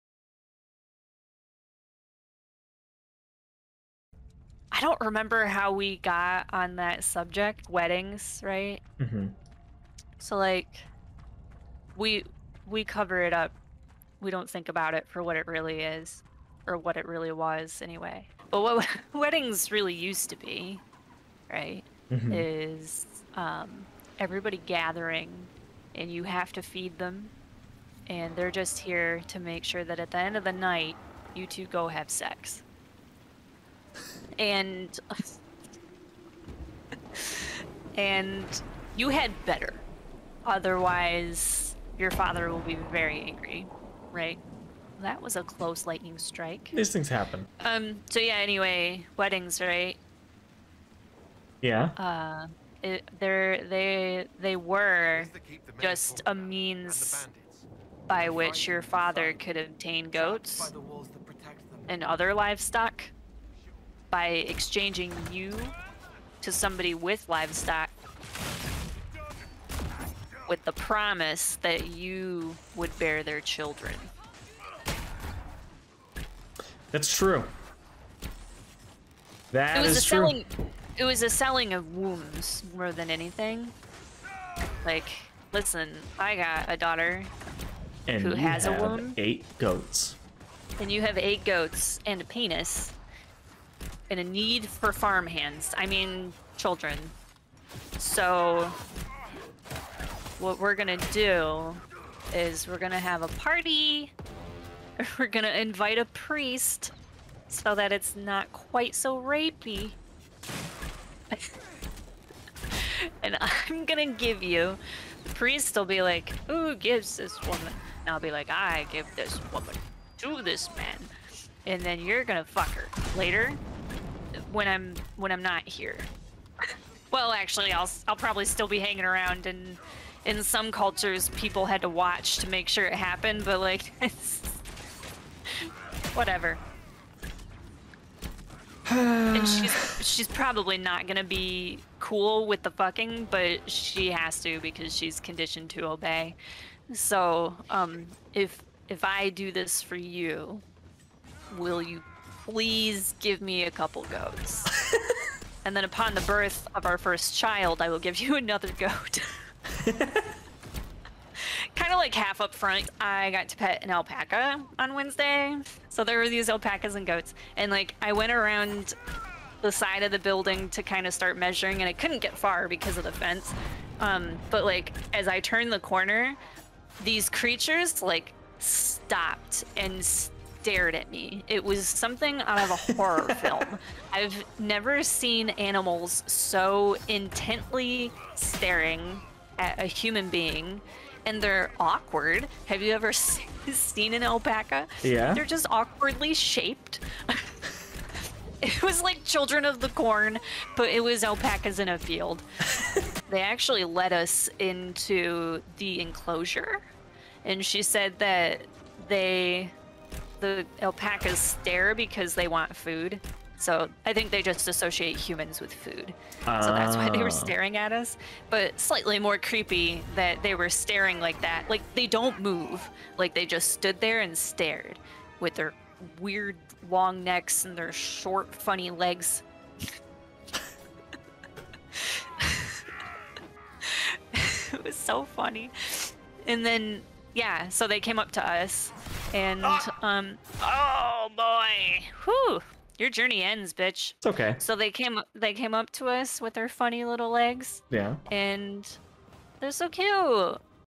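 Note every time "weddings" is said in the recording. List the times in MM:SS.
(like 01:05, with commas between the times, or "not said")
00:07, 00:19, 00:49.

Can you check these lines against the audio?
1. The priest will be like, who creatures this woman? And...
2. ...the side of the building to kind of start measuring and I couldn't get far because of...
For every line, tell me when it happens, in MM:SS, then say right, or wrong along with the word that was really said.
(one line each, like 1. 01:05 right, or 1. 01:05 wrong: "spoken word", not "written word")
1. 01:55 wrong: "gives", not "creatures"
2. 02:49 right.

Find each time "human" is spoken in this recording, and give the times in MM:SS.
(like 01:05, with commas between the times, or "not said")
03:09, 03:35.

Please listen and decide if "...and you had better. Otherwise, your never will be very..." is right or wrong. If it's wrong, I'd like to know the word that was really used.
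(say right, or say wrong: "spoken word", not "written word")
wrong: "father", not "never".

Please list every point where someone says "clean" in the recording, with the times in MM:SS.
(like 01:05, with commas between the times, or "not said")
not said.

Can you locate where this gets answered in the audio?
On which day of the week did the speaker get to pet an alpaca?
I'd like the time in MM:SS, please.
02:44.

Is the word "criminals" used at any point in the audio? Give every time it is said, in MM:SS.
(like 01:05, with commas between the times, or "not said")
not said.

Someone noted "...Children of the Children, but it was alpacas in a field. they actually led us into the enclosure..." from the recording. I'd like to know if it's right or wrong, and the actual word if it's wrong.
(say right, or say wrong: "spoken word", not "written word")
wrong: "Corn", not "Children".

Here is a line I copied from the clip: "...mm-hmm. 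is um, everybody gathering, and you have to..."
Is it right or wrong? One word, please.
right.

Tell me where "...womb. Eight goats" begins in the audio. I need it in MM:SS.
01:28.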